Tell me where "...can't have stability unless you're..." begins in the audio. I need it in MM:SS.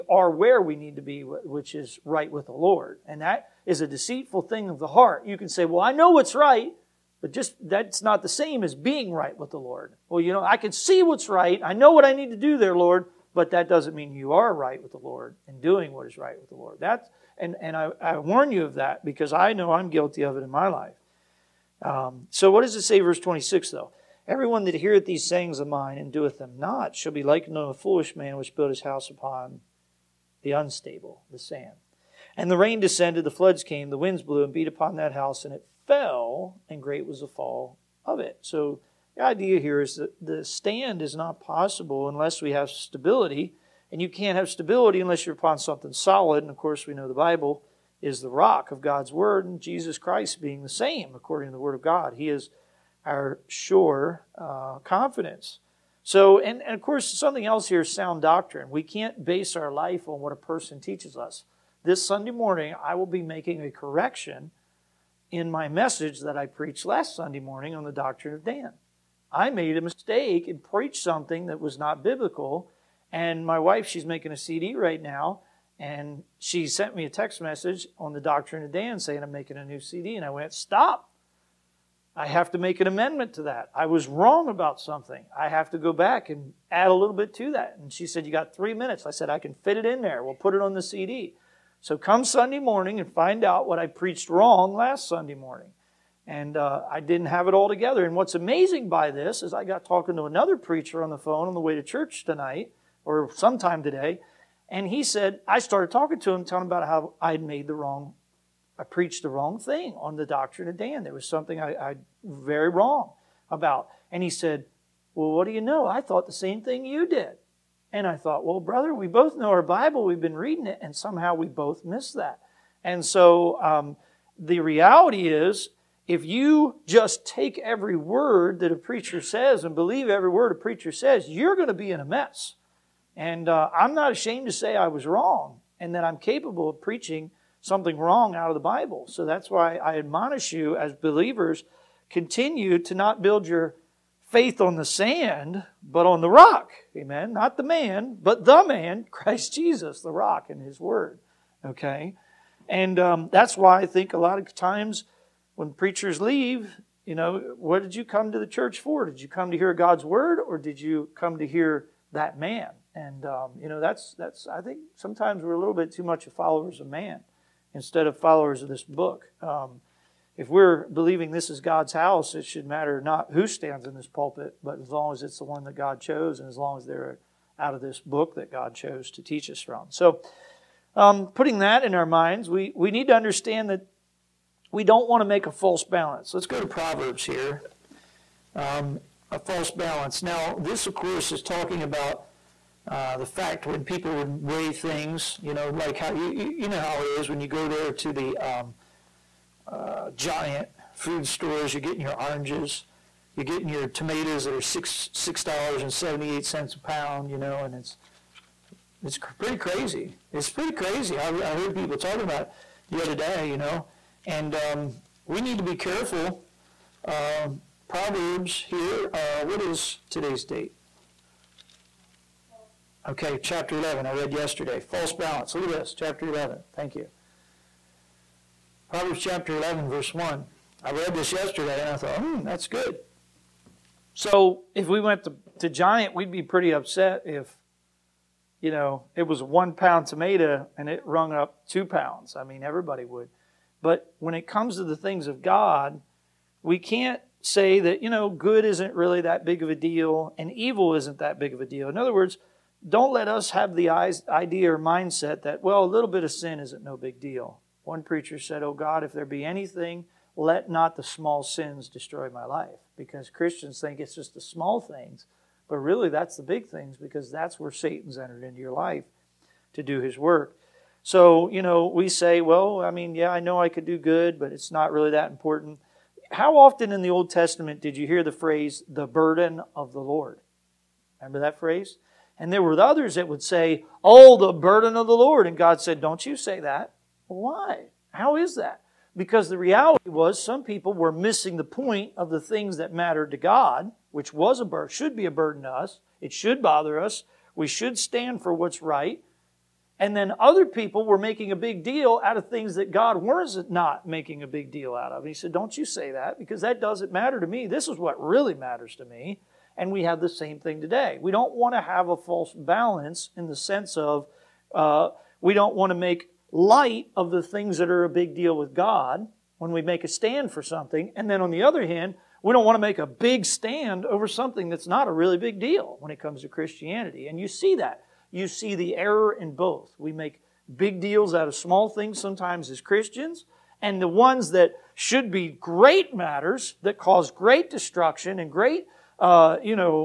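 00:44.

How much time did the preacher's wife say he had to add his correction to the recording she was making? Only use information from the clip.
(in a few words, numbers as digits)
3 minutes.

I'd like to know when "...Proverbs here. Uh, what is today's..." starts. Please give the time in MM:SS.
03:37.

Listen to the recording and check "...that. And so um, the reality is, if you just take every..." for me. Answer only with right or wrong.
right.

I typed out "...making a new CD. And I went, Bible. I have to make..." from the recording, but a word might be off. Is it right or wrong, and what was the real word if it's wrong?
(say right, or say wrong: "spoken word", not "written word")
wrong: "Stop", not "Bible".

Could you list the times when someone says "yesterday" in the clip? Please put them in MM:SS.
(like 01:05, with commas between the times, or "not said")
03:44, 03:51.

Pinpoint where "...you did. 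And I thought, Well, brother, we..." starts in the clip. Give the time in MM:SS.
01:56.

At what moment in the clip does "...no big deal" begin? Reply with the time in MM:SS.
04:16.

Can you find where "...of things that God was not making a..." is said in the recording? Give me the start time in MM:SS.
05:02.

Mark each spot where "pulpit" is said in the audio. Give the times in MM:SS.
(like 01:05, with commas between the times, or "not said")
02:54.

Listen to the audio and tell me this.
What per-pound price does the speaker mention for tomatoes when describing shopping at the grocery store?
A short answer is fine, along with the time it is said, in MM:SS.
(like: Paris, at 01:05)
$6.78, at 03:25.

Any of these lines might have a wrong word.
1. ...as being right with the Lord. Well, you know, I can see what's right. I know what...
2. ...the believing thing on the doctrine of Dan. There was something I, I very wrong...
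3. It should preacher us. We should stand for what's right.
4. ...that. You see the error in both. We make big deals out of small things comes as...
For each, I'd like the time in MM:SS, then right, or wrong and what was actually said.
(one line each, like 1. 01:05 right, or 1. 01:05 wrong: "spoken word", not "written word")
1. 00:08 right
2. 01:49 wrong: "wrong", not "believing"
3. 04:56 wrong: "bother", not "preacher"
4. 05:27 wrong: "sometimes", not "comes".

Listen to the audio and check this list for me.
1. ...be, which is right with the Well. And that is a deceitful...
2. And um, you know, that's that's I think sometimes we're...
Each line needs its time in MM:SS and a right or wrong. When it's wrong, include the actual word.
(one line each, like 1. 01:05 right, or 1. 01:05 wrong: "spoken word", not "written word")
1. 00:01 wrong: "Lord", not "Well"
2. 02:42 right.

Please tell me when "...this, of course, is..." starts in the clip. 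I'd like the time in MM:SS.
03:10.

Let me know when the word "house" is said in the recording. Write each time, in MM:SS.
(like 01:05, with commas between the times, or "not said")
00:28, 00:35, 02:51.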